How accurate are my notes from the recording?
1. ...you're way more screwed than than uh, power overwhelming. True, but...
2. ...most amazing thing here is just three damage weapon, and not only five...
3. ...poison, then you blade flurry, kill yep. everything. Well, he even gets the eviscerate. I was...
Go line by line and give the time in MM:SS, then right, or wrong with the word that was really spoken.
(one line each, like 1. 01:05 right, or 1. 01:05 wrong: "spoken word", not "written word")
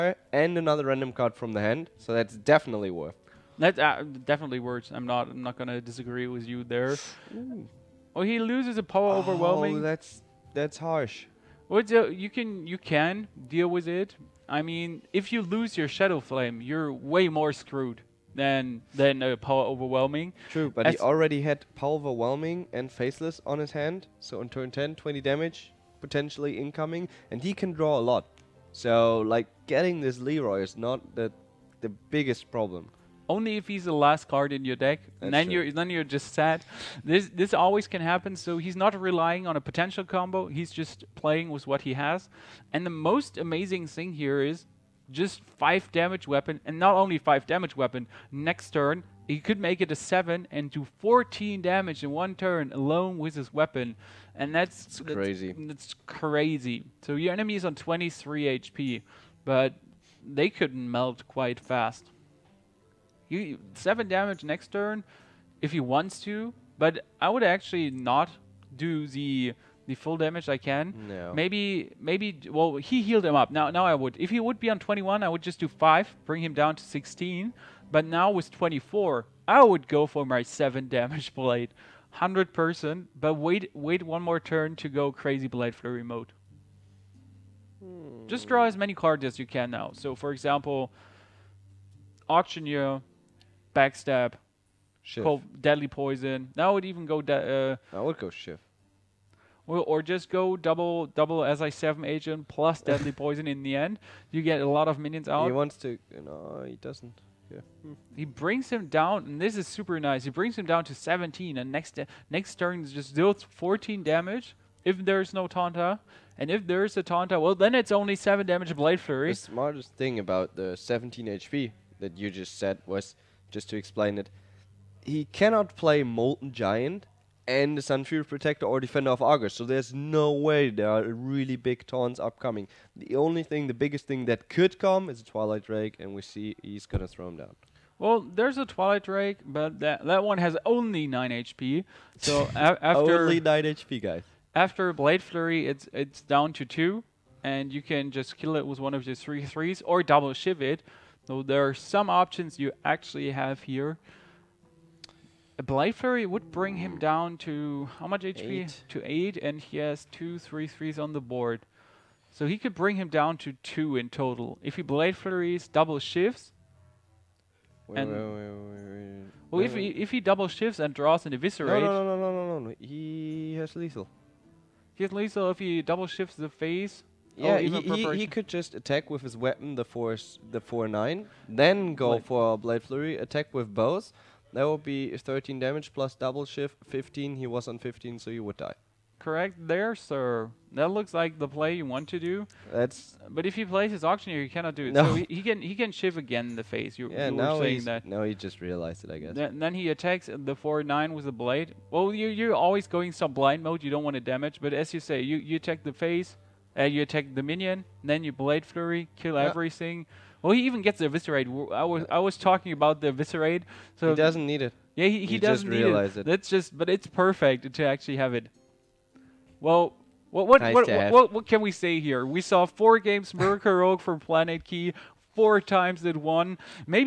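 1. 00:16 right
2. 00:43 wrong: "five", not "three"
3. 03:27 wrong: "minion", not "poison".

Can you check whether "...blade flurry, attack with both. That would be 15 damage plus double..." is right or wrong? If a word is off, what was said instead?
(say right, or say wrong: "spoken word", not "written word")
wrong: "13", not "15".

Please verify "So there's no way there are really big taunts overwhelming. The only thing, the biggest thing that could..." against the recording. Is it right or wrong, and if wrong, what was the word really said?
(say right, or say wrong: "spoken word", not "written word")
wrong: "upcoming", not "overwhelming".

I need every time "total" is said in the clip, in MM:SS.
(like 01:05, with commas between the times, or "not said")
02:44.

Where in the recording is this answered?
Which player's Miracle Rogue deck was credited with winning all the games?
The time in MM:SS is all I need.
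03:44.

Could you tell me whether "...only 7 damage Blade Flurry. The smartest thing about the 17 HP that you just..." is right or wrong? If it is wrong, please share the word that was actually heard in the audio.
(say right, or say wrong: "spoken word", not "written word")
right.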